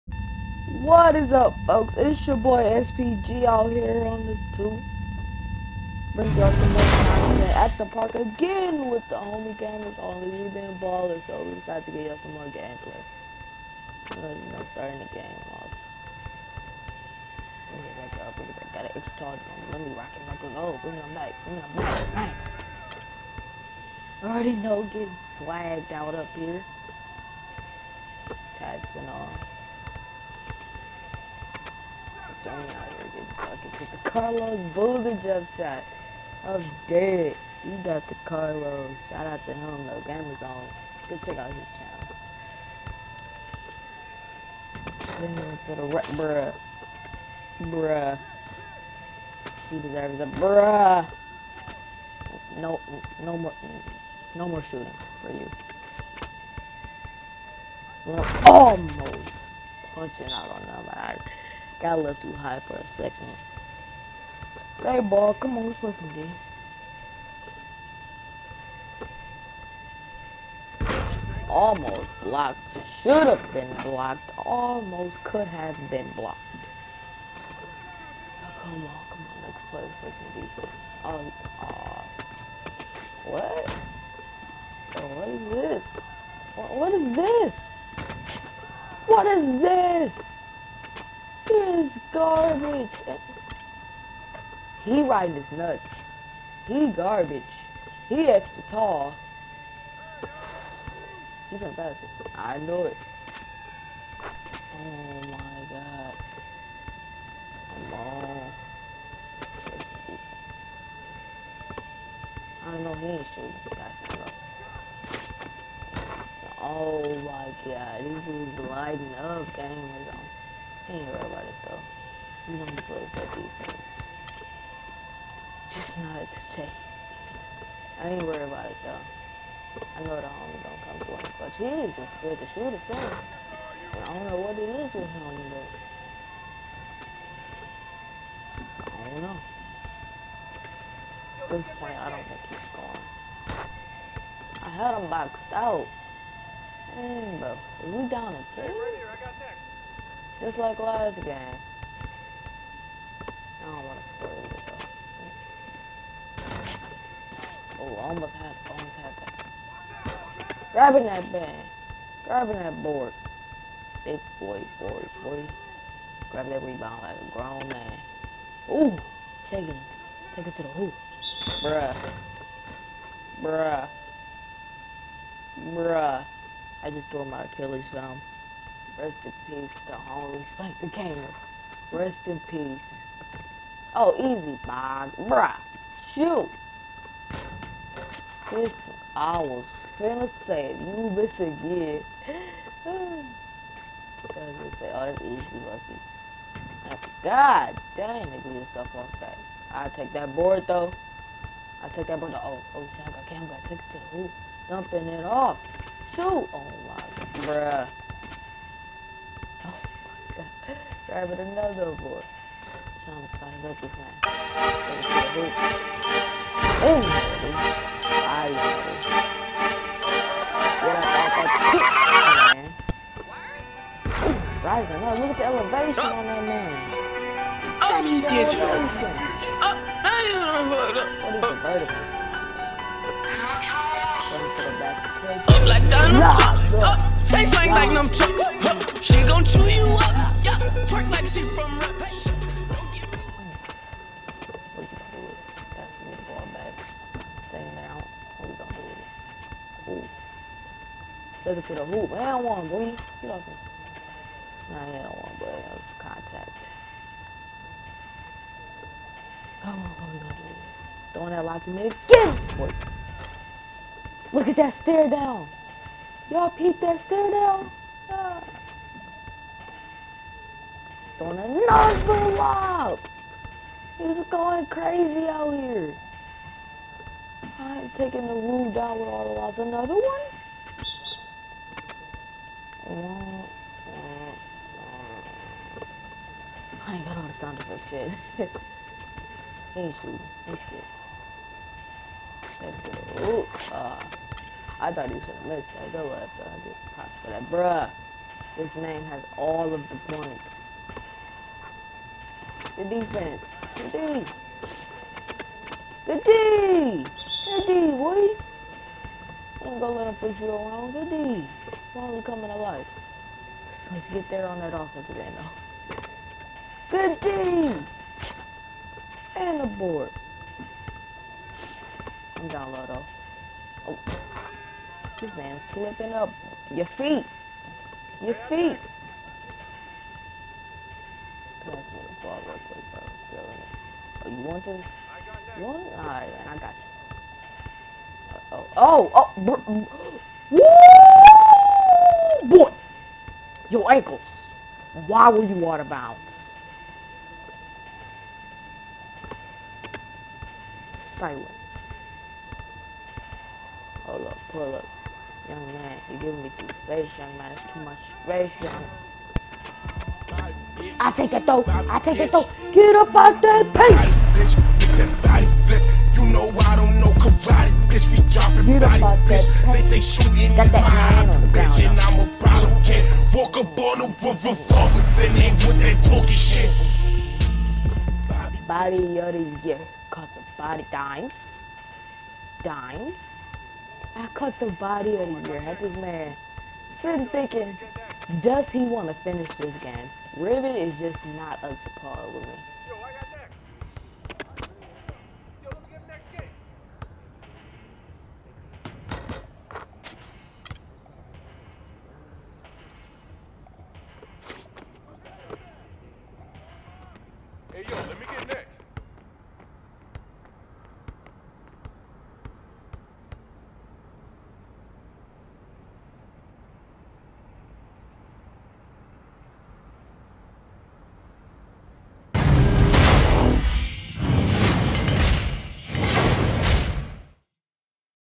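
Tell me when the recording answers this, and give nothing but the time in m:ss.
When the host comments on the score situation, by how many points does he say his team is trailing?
2:28.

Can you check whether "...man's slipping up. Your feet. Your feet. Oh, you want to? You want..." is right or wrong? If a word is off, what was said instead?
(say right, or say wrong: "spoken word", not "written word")
right.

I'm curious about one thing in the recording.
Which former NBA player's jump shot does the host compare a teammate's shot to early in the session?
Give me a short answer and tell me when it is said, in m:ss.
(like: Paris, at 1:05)
Carlos Boozer, at 0:34.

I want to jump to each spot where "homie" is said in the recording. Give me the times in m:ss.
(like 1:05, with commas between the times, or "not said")
0:09, 2:10, 2:59.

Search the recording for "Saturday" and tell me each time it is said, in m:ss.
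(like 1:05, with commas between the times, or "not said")
not said.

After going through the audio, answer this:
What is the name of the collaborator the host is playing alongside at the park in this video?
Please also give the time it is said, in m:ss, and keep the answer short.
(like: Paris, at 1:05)
GamerzOnly, at 0:09.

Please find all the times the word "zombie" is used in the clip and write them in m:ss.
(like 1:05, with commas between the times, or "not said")
not said.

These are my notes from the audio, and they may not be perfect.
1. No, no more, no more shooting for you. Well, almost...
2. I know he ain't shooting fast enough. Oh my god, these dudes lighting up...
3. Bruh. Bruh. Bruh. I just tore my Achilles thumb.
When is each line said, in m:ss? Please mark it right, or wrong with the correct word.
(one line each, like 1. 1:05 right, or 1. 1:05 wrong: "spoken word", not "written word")
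1. 0:52 right
2. 1:52 right
3. 2:51 right.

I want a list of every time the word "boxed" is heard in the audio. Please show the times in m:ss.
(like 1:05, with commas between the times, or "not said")
2:25.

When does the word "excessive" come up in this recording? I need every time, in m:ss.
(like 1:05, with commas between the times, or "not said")
not said.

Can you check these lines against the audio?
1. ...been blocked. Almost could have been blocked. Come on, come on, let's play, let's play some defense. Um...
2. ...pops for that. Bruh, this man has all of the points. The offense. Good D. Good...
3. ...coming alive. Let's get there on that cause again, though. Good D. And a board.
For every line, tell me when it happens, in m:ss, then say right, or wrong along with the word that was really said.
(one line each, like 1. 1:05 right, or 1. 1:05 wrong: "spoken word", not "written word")
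1. 1:13 right
2. 4:56 wrong: "defense", not "offense"
3. 5:12 wrong: "offense", not "cause".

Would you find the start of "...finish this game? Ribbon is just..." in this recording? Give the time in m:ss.
6:29.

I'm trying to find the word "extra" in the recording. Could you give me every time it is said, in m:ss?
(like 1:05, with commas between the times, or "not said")
0:18, 1:38.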